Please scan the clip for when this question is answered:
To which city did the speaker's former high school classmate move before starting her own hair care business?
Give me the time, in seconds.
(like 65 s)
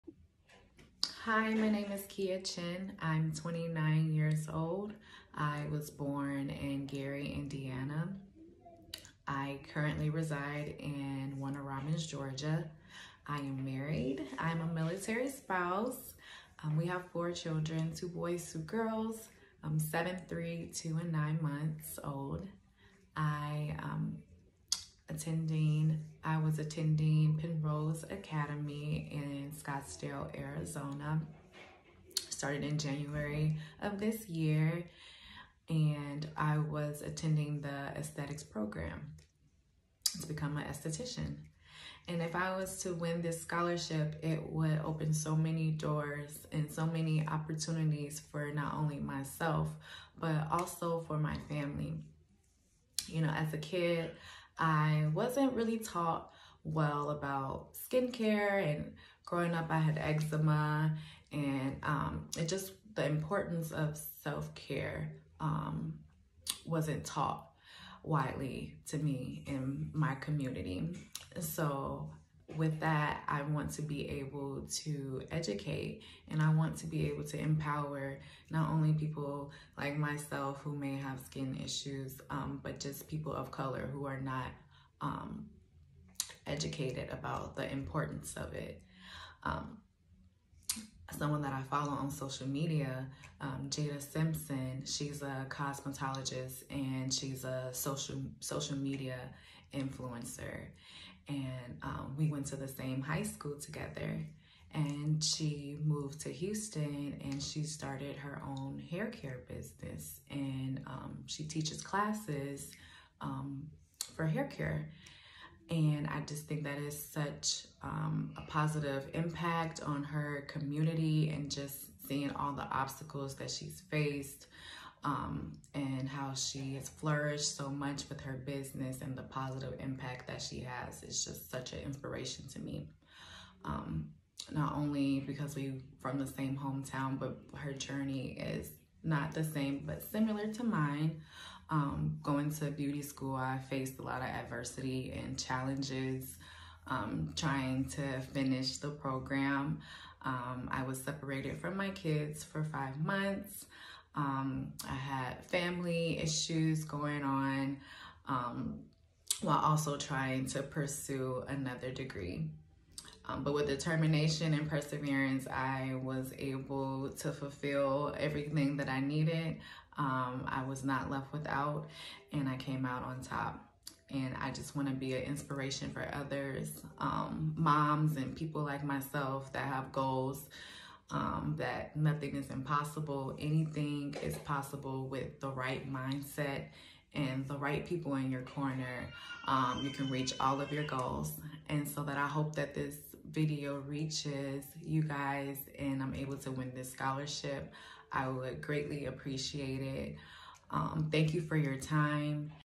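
106 s.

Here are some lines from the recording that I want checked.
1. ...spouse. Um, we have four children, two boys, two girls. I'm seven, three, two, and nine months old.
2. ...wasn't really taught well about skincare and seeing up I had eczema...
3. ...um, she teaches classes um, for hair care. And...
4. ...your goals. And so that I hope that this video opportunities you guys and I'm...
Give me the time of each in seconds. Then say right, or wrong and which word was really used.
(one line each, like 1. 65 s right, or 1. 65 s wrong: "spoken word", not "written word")
1. 15 s right
2. 55 s wrong: "growing", not "seeing"
3. 110 s right
4. 190 s wrong: "reaches", not "opportunities".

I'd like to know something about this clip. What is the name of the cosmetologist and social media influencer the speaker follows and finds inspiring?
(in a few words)
Jada Simpson.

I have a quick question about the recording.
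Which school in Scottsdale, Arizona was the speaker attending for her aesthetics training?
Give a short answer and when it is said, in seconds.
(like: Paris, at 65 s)
Penrose Academy, at 27 s.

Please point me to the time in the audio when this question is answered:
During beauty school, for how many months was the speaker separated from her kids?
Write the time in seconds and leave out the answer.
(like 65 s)
152 s.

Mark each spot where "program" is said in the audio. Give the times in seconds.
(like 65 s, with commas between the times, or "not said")
38 s, 148 s.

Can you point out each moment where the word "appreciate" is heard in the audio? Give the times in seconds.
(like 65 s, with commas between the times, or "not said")
199 s.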